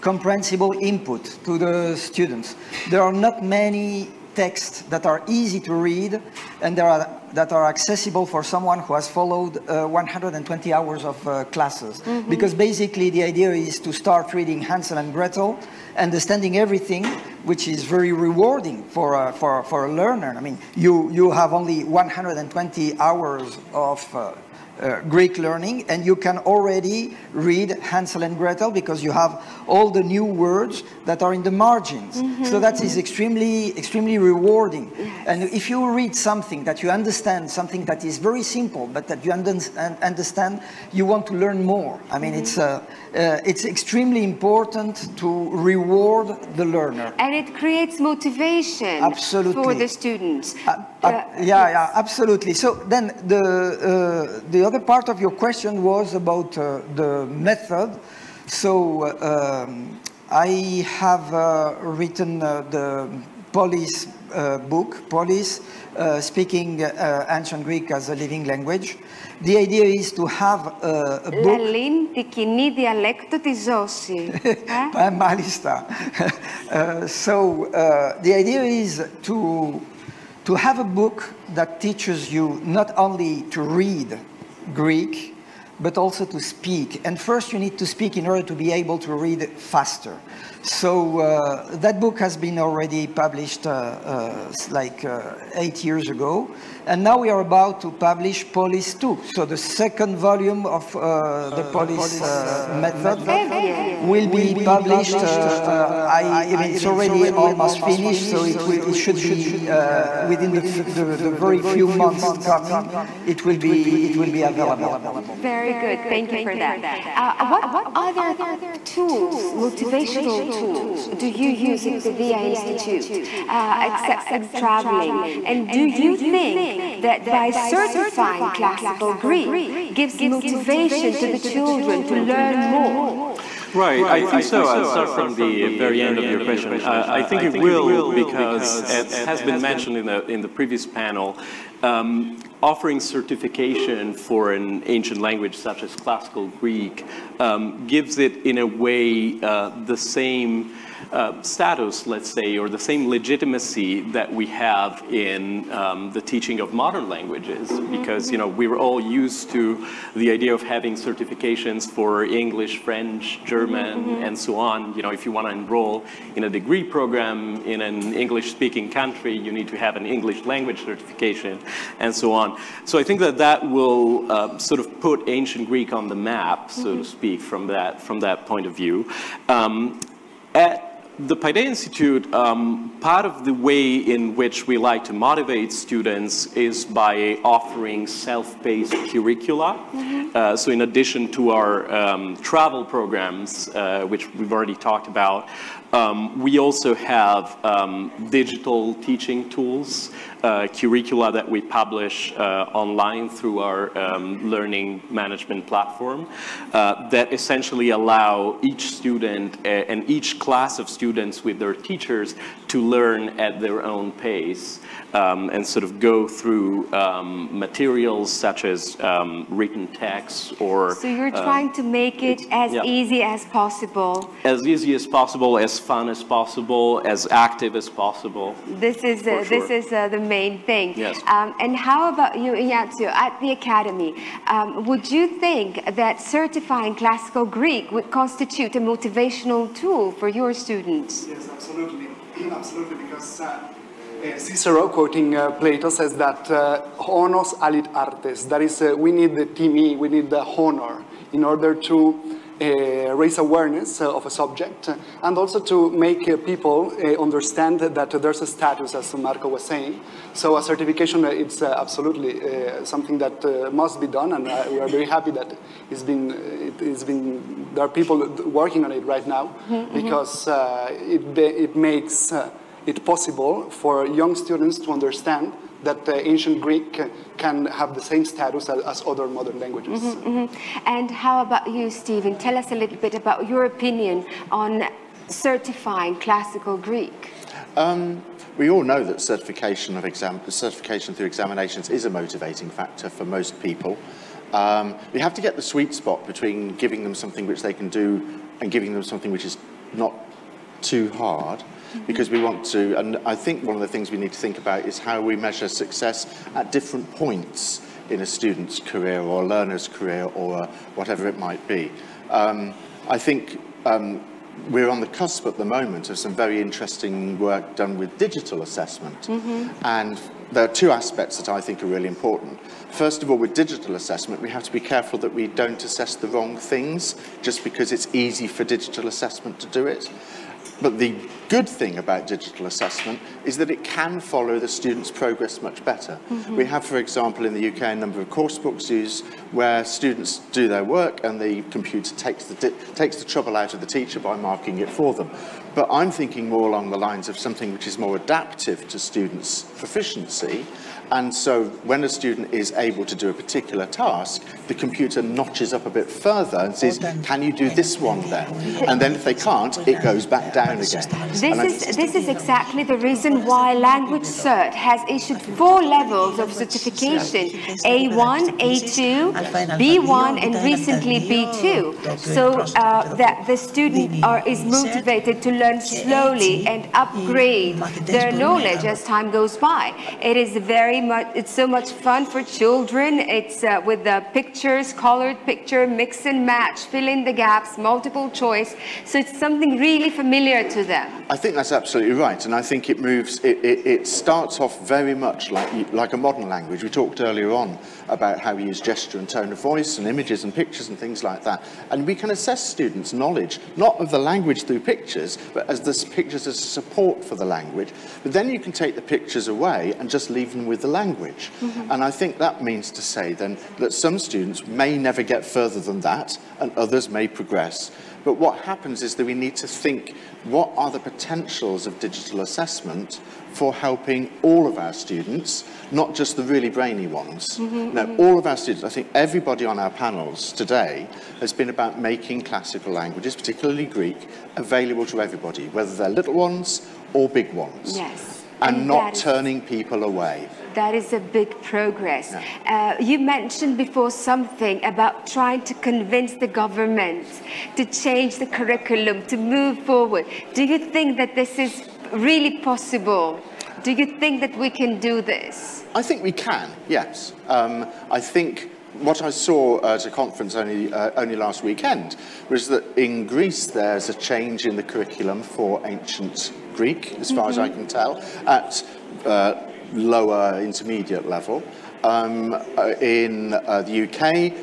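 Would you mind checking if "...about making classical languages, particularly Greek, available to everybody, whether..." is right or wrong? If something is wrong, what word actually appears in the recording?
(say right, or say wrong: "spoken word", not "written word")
right.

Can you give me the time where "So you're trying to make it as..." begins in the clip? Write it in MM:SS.
03:40.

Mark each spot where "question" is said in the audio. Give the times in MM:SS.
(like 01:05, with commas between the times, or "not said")
00:55, 02:16.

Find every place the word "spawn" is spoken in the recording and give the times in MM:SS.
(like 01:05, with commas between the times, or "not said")
not said.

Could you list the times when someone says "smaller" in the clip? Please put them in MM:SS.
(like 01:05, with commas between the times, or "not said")
not said.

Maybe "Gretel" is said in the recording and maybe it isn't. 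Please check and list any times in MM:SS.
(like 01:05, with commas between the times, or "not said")
00:15, 00:28.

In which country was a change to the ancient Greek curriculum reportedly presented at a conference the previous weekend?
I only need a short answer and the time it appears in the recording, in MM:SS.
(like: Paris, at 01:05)
Greece, at 07:43.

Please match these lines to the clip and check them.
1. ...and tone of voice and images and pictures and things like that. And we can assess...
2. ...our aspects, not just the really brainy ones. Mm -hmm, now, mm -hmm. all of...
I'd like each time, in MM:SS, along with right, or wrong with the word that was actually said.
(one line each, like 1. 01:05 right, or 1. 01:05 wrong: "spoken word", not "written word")
1. 06:39 right
2. 07:04 wrong: "students", not "aspects".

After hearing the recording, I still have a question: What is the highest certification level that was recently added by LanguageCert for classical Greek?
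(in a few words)
B2.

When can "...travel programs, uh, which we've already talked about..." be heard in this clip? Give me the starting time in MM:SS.
03:12.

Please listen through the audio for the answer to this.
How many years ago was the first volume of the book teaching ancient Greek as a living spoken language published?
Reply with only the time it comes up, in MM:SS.
01:35.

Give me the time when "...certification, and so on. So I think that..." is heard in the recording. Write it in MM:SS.
02:50.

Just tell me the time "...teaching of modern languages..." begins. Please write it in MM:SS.
02:36.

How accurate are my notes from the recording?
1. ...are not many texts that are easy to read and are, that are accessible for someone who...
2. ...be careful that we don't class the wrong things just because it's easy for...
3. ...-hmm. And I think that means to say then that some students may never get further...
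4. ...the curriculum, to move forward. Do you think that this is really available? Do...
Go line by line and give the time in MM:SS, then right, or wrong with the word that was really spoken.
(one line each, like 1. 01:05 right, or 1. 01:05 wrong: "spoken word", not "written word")
1. 00:03 right
2. 05:24 wrong: "assess", not "class"
3. 06:51 right
4. 07:28 wrong: "possible", not "available".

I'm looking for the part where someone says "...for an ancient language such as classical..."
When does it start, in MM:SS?
02:24.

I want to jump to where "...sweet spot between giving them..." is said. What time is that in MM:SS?
04:55.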